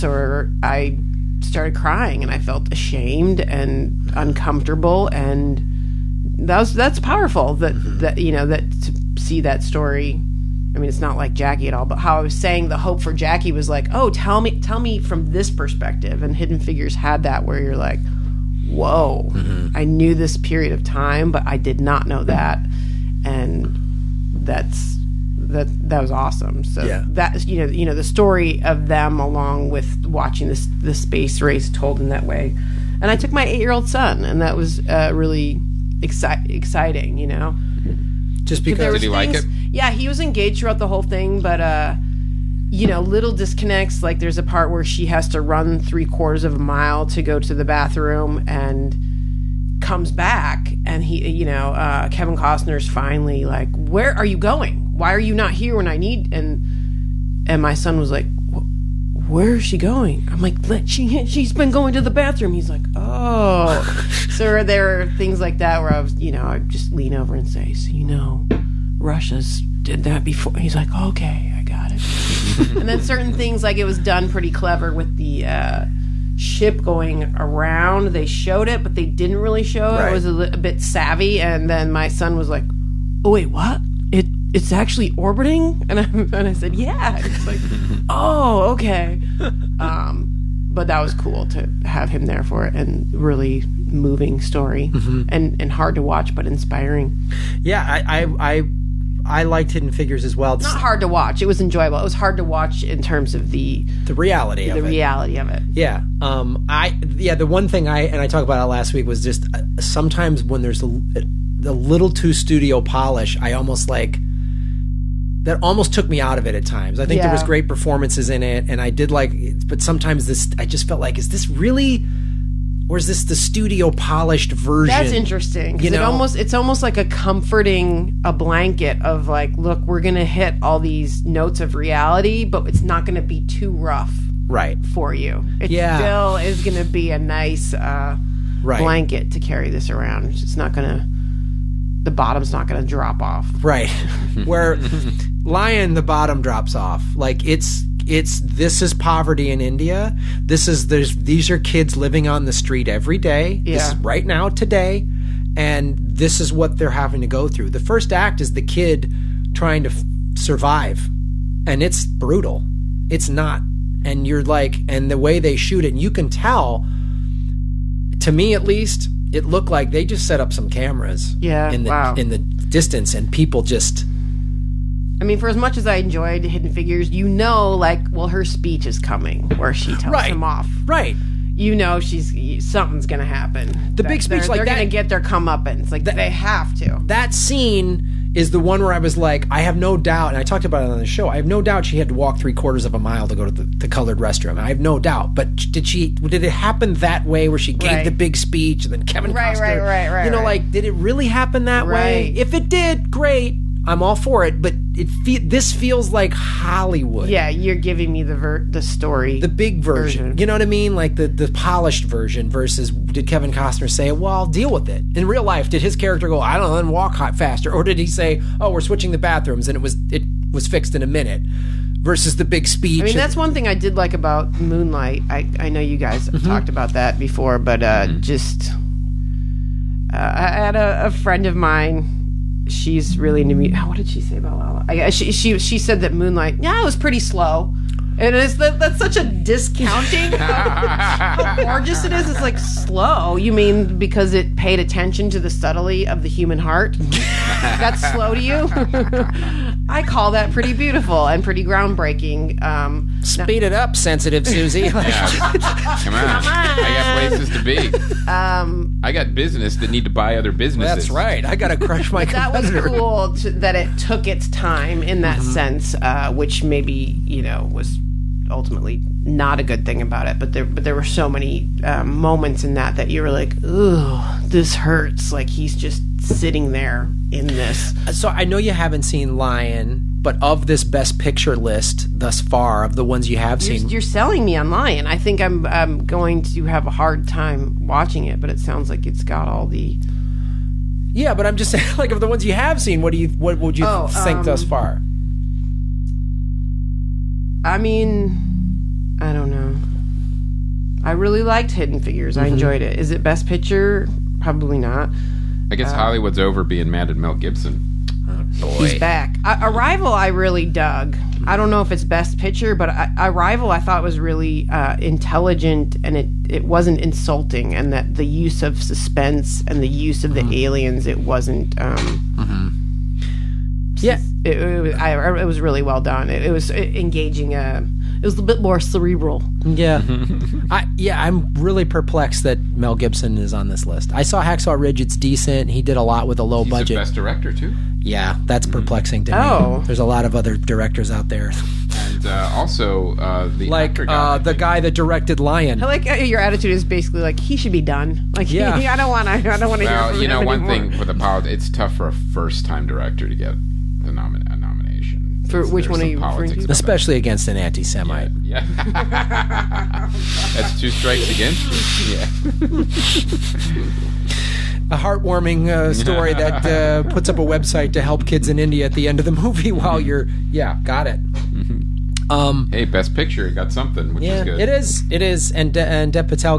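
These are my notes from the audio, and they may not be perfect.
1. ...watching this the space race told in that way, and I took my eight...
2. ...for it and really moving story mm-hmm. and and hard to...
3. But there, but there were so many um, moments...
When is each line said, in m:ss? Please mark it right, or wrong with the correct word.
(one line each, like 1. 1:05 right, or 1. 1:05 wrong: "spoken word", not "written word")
1. 0:30 right
2. 1:32 right
3. 4:30 right.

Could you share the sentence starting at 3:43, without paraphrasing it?
I mean, that's one thing I did like about Moonlight.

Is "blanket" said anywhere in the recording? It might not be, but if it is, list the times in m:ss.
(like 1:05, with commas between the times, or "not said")
2:08, 2:18.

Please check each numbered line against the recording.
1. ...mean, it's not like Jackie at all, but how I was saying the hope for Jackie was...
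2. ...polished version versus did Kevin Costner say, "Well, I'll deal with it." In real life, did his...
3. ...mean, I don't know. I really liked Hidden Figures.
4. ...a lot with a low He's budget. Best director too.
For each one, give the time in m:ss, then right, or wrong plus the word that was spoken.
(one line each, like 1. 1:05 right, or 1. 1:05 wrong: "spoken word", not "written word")
1. 0:10 right
2. 3:31 right
3. 4:57 right
4. 5:35 right.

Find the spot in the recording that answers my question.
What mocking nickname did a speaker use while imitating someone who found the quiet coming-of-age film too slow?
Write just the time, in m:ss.
4:13.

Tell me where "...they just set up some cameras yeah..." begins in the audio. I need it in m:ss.
2:49.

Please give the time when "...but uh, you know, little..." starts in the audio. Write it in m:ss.
0:41.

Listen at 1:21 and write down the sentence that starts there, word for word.
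And then my son was like, "Oh wait, what?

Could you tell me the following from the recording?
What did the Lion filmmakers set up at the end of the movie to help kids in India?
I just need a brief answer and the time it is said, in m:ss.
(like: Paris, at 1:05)
A website, at 6:07.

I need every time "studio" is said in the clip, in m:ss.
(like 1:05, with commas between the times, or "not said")
1:52, 2:03.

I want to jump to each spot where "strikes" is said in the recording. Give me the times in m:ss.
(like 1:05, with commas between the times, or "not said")
6:00.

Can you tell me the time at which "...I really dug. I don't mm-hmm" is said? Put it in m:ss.
5:10.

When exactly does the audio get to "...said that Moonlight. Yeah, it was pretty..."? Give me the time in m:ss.
3:55.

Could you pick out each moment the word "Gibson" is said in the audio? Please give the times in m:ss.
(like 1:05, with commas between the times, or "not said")
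5:07, 5:32.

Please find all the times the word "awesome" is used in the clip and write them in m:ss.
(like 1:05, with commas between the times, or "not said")
0:26.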